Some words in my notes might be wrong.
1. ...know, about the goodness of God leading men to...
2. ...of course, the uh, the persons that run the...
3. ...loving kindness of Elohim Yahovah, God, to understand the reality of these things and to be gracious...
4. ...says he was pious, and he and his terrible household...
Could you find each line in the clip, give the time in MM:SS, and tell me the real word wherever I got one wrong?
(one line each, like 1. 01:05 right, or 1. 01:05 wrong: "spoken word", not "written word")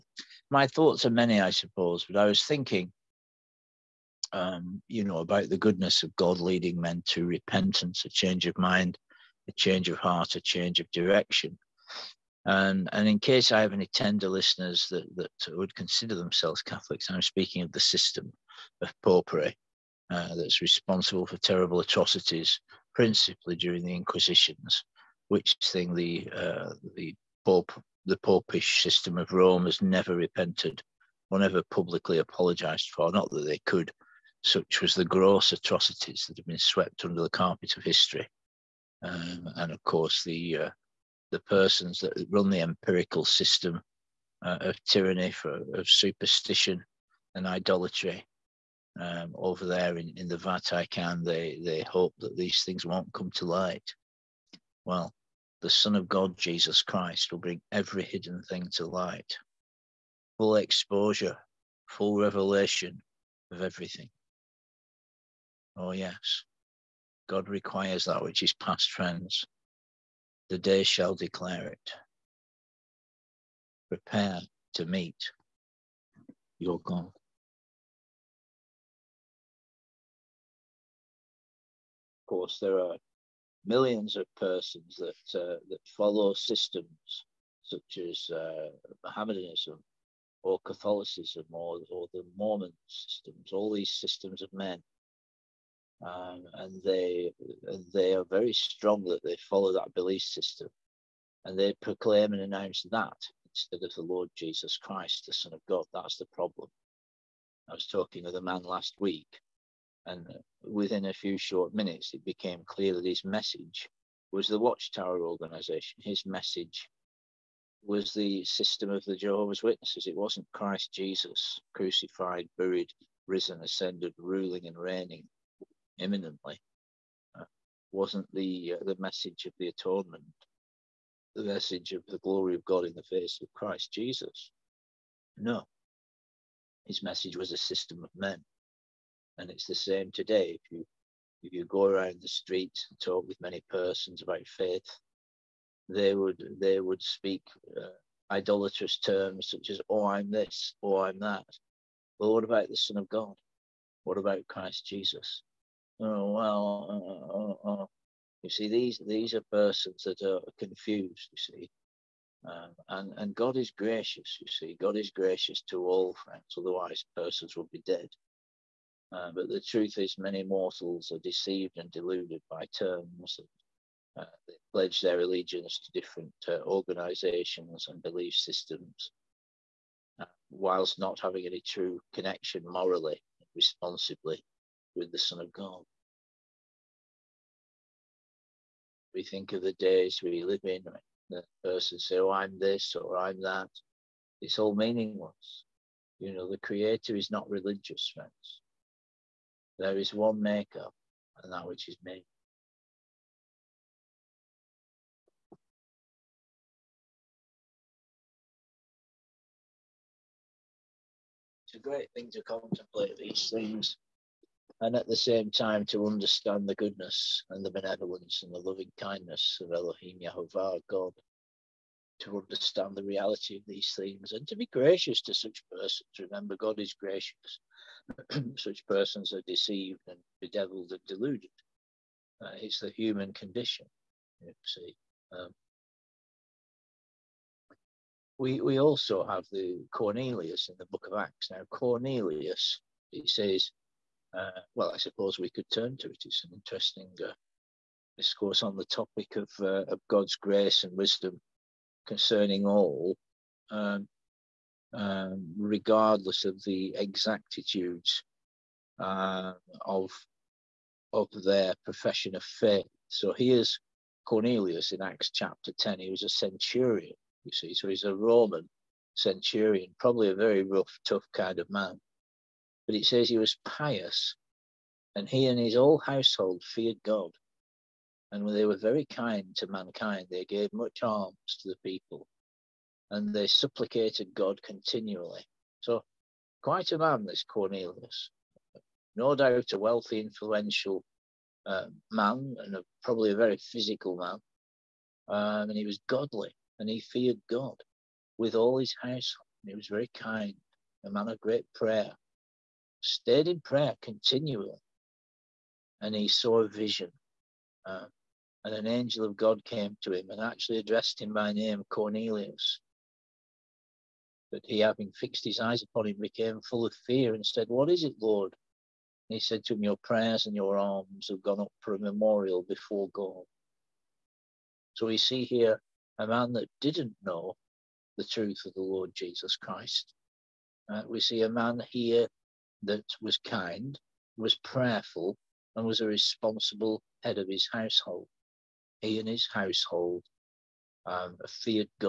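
1. 00:05 right
2. 00:39 right
3. 03:38 right
4. 04:33 wrong: "whole", not "terrible".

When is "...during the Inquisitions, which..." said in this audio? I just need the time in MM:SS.
00:23.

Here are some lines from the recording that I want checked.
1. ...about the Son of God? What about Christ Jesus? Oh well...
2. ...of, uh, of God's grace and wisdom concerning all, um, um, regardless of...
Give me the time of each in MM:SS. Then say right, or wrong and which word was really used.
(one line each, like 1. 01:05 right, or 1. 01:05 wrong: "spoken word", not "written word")
1. 02:32 right
2. 04:09 right.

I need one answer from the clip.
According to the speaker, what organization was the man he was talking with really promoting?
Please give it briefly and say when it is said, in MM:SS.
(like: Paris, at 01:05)
The Watchtower organization, at 01:54.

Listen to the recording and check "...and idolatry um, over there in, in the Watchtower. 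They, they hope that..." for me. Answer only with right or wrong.
wrong.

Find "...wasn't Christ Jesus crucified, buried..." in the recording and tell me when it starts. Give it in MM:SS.
02:00.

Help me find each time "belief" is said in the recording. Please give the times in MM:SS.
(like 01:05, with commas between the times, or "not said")
01:39, 02:58.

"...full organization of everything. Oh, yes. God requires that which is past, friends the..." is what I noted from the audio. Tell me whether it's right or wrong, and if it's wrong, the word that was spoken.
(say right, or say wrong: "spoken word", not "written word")
wrong: "revelation", not "organization".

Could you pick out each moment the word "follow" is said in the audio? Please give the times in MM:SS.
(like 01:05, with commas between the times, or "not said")
01:25, 01:39.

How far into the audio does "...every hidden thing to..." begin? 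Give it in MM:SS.
00:57.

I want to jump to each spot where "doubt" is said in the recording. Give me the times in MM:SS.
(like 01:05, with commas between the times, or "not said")
04:49.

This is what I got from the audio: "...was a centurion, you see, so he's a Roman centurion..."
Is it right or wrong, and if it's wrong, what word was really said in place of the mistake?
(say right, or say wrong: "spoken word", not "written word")
right.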